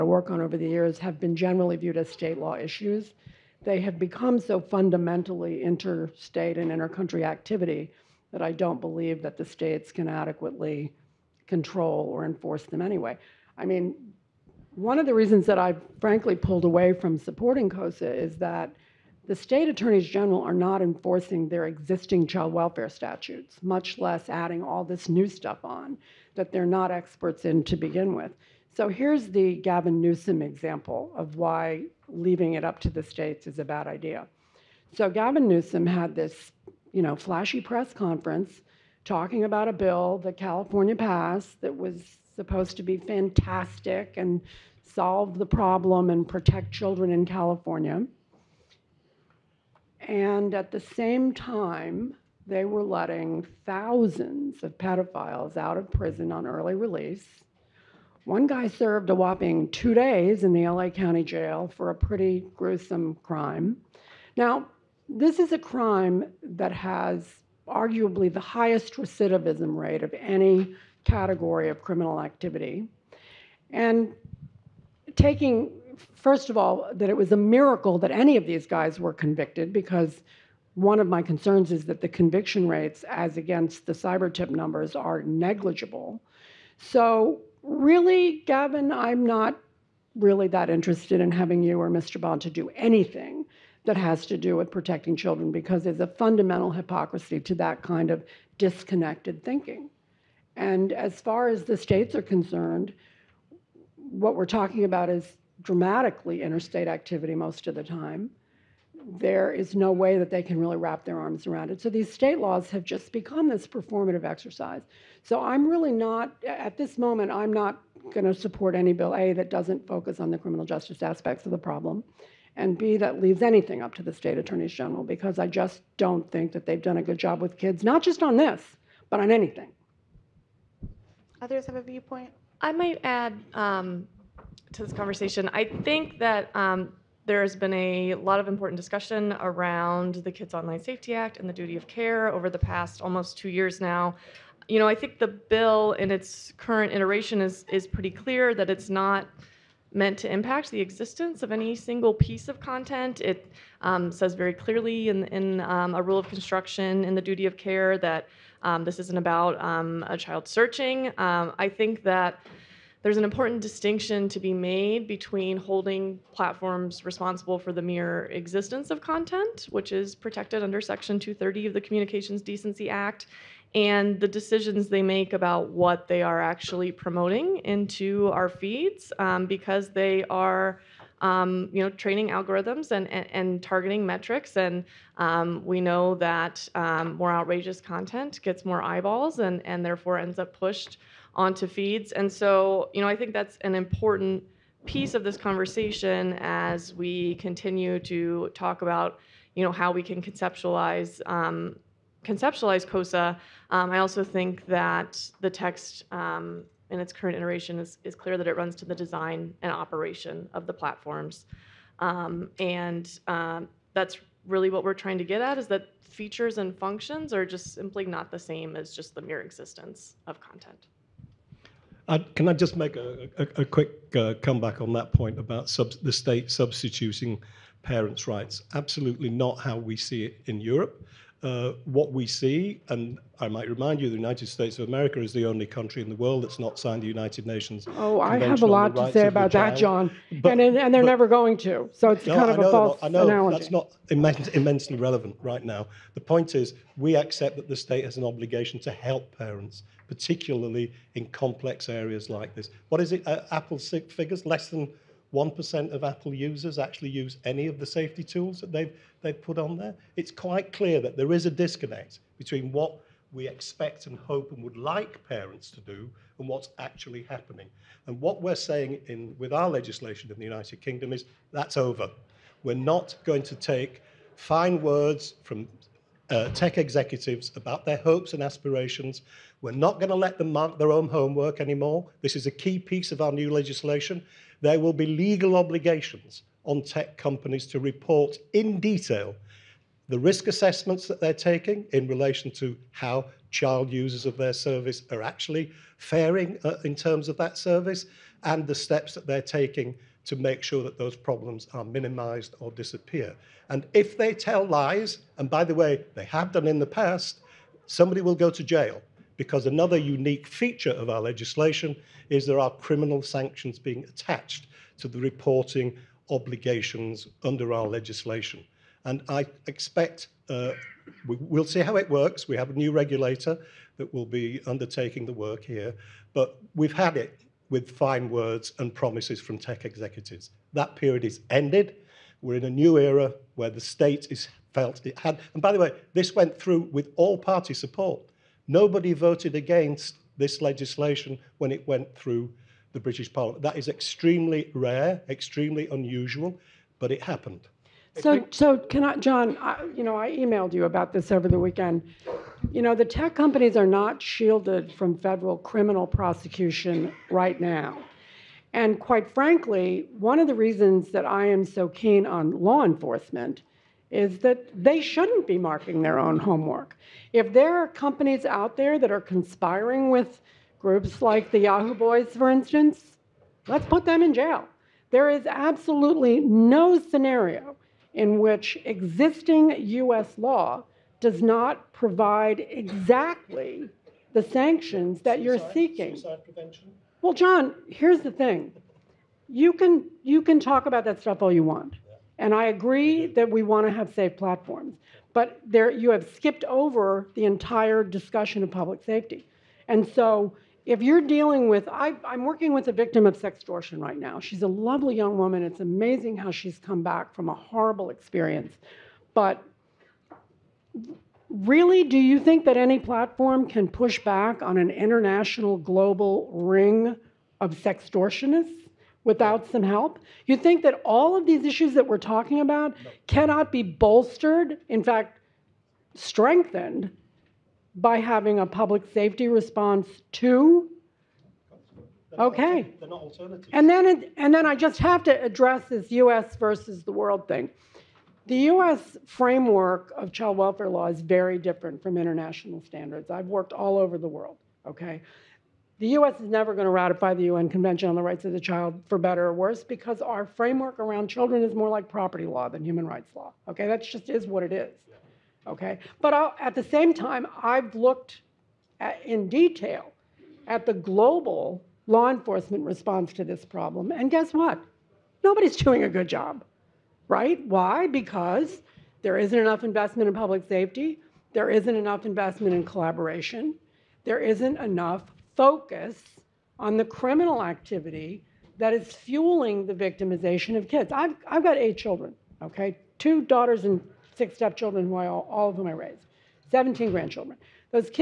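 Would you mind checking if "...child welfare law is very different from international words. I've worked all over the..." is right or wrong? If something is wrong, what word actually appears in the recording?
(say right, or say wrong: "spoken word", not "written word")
wrong: "standards", not "words".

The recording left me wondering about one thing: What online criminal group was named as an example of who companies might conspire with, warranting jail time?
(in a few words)
Yahoo Boys.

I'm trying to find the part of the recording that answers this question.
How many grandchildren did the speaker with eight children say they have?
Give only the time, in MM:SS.
08:06.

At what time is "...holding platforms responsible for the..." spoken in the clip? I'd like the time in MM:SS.
02:45.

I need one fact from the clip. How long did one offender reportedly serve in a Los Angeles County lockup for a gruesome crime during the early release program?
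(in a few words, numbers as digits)
2 days.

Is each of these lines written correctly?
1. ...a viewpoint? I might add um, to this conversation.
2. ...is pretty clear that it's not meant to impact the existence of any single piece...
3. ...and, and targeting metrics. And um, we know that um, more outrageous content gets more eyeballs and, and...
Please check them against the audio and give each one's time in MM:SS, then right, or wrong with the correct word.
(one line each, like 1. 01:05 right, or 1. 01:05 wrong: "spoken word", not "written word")
1. 02:11 right
2. 02:27 right
3. 03:03 right.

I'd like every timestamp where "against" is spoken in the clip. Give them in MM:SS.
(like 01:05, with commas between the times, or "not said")
01:23, 05:39.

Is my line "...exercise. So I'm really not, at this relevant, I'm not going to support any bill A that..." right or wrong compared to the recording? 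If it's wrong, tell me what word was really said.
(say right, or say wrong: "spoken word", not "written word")
wrong: "moment", not "relevant".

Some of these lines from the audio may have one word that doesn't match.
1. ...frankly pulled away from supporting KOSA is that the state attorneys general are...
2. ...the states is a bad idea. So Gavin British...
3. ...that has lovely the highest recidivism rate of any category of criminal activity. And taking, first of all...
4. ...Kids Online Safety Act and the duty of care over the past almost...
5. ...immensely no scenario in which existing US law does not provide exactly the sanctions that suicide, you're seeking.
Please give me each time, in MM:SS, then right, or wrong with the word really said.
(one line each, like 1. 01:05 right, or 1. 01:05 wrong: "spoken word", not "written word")
1. 00:16 right
2. 00:32 wrong: "Newsom", not "British"
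3. 01:06 wrong: "arguably", not "lovely"
4. 02:20 right
5. 06:15 wrong: "absolutely", not "immensely".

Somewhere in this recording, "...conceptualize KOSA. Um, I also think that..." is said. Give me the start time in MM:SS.
03:22.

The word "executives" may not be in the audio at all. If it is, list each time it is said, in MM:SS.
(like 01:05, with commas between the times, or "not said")
04:36, 05:29.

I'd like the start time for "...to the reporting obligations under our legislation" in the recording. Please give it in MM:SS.
05:14.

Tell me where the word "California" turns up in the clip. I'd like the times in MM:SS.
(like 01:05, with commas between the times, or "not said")
00:40, 00:47.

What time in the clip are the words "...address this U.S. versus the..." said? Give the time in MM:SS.
07:15.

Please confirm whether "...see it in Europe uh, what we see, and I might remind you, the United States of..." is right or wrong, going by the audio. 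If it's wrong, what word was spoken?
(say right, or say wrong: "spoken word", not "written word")
right.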